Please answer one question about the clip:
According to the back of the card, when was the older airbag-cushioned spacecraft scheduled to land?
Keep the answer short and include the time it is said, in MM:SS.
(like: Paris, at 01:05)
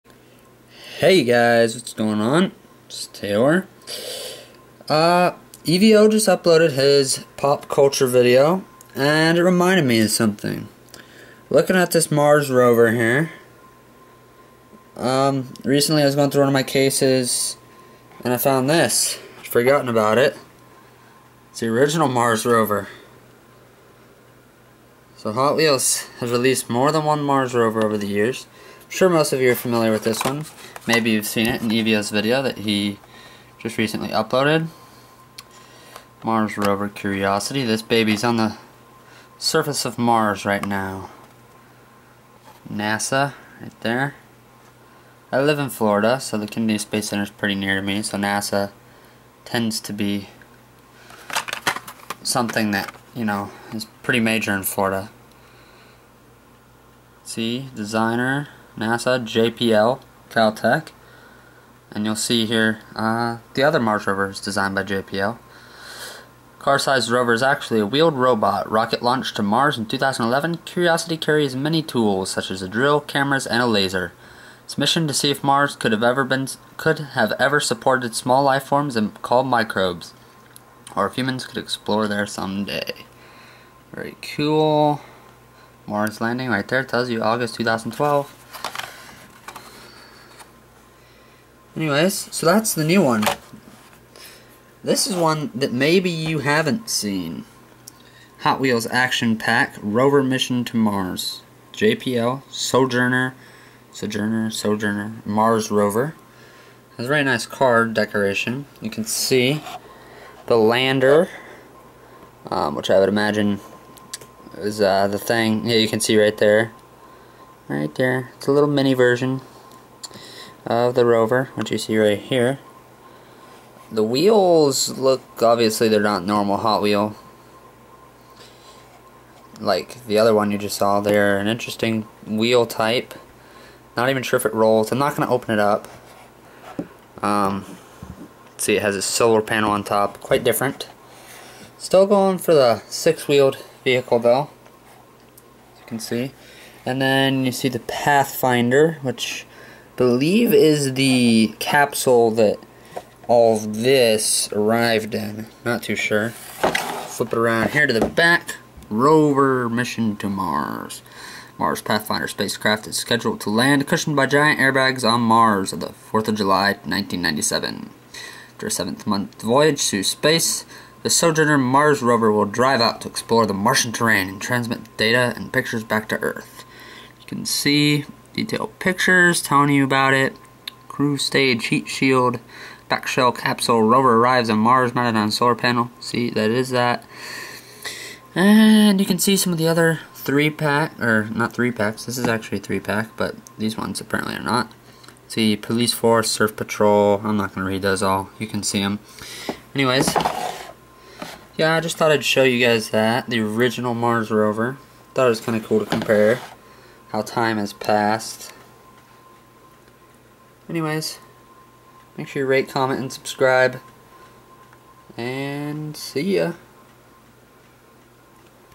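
4th of July 1997, at 02:46.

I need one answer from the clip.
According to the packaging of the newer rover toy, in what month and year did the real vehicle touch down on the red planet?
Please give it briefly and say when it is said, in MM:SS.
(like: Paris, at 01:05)
August 2012, at 01:27.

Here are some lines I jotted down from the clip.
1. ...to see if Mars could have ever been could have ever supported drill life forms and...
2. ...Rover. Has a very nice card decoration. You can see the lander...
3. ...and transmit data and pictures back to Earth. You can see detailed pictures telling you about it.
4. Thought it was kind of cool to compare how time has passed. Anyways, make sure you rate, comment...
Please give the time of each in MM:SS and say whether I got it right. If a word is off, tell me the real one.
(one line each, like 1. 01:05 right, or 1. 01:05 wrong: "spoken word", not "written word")
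1. 01:15 wrong: "small", not "drill"
2. 01:45 right
3. 02:54 right
4. 03:25 right.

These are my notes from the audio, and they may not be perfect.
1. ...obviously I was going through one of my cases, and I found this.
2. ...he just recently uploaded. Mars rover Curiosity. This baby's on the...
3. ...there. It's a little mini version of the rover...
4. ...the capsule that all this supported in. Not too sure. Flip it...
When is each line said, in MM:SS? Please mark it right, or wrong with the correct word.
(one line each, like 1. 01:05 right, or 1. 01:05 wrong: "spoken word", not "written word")
1. 00:15 wrong: "recently", not "obviously"
2. 00:32 right
3. 01:57 right
4. 02:30 wrong: "arrived", not "supported".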